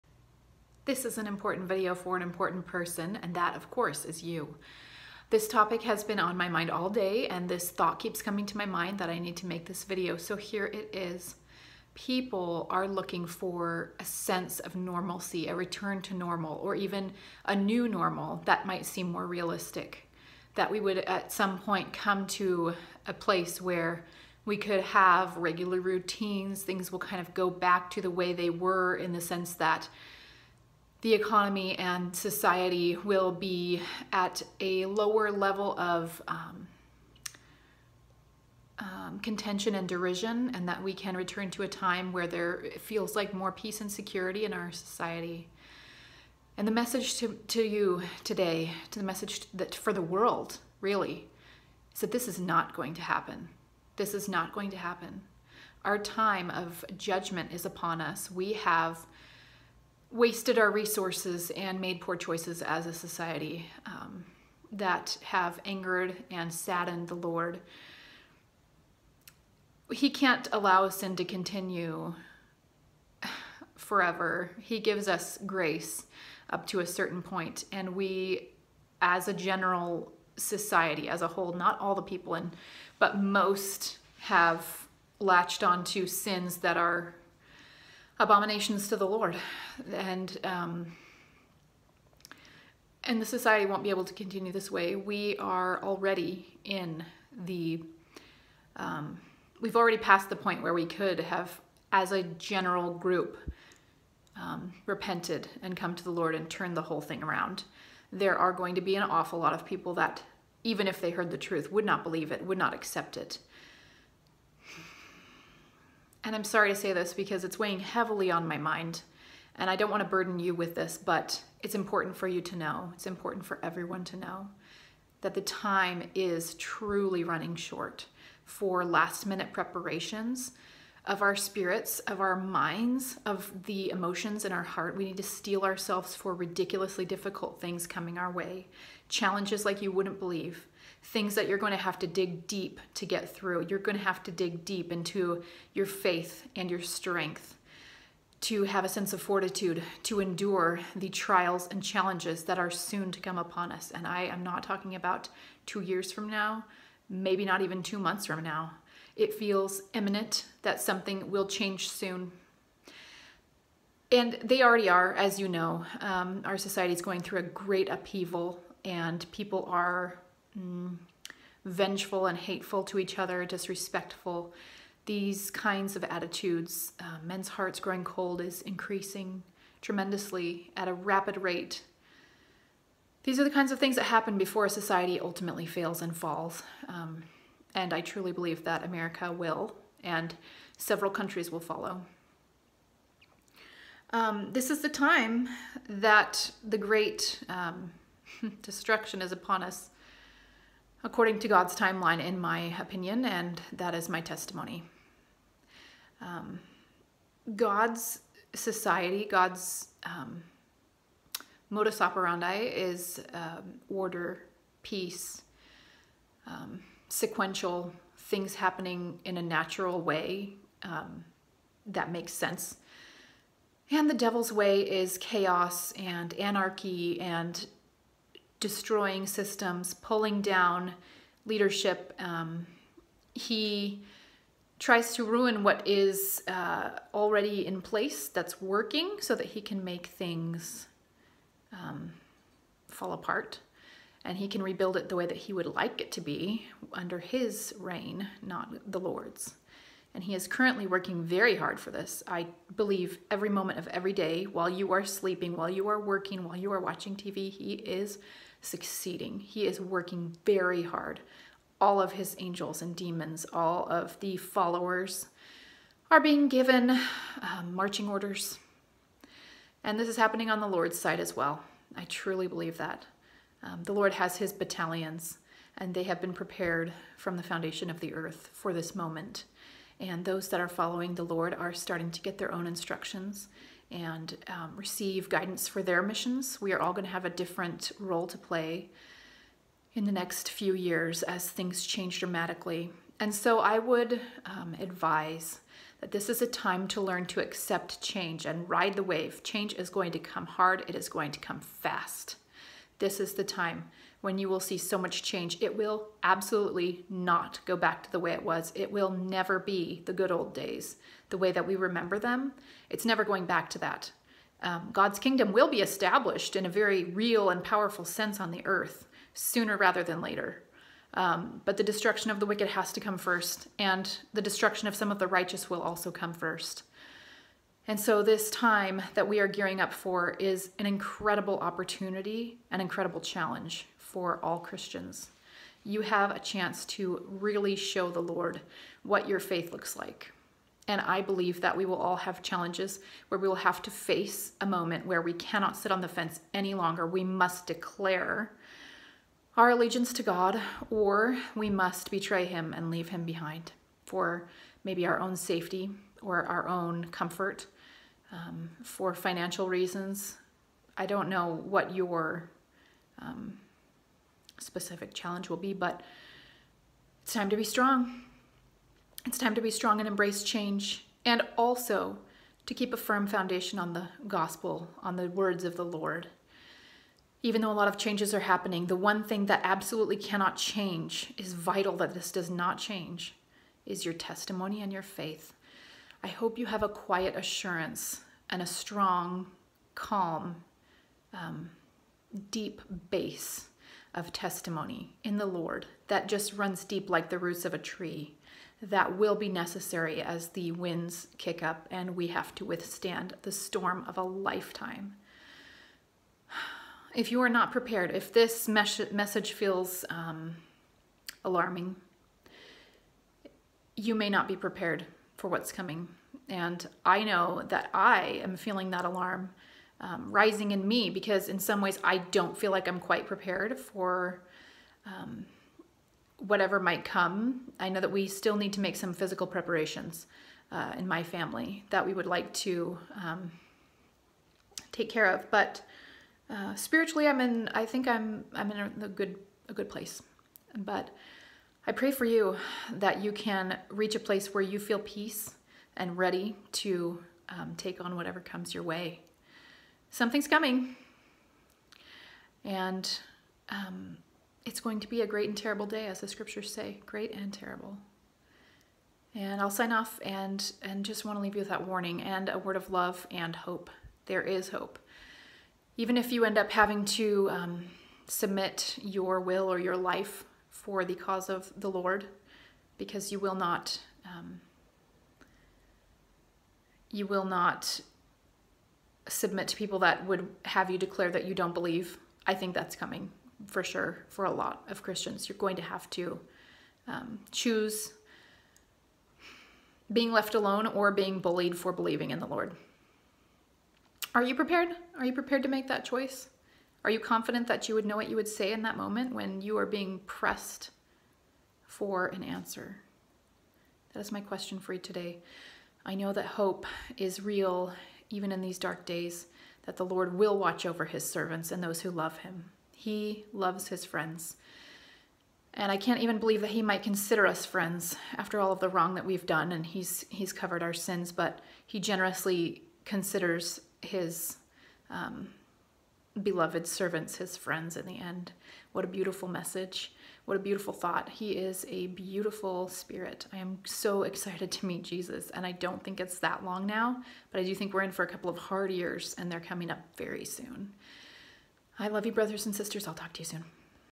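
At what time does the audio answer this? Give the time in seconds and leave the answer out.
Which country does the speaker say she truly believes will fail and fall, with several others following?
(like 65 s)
188 s.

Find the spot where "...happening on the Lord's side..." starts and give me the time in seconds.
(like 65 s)
270 s.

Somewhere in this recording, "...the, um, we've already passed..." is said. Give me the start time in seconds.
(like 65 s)
97 s.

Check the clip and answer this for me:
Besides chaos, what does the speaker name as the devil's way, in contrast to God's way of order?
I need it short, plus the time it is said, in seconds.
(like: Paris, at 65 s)
anarchy, at 226 s.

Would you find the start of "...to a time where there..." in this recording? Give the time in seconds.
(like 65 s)
41 s.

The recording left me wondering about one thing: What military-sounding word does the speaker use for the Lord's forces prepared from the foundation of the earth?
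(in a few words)
battalions.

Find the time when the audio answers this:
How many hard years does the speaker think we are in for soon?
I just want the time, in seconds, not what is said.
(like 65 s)
538 s.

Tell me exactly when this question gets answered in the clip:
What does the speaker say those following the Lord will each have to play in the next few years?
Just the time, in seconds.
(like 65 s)
287 s.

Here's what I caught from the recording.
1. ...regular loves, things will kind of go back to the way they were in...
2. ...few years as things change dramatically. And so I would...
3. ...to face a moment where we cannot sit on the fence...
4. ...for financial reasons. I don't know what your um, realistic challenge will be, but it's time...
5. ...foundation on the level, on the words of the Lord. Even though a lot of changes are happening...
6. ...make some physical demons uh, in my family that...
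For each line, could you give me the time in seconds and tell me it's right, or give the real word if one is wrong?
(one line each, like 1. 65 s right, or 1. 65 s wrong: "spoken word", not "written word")
1. 25 s wrong: "routines", not "loves"
2. 290 s right
3. 343 s right
4. 358 s wrong: "specific", not "realistic"
5. 373 s wrong: "gospel", not "level"
6. 428 s wrong: "preparations", not "demons".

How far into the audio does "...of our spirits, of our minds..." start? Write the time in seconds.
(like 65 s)
131 s.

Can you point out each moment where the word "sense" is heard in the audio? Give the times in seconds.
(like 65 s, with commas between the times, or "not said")
14 s, 29 s, 148 s, 222 s, 318 s.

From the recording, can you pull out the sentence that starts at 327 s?
And so, this time that we are gearing up for is an incredible opportunity, an incredible challenge for all Christians.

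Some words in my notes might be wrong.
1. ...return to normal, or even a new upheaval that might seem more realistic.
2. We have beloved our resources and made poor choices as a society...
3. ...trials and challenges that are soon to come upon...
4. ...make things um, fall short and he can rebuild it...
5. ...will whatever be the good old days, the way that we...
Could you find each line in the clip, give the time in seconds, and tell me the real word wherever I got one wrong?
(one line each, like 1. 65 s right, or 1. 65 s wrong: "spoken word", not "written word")
1. 15 s wrong: "normal", not "upheaval"
2. 58 s wrong: "wasted", not "beloved"
3. 151 s right
4. 239 s wrong: "apart", not "short"
5. 308 s wrong: "never", not "whatever".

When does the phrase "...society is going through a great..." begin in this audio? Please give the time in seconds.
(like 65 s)
166 s.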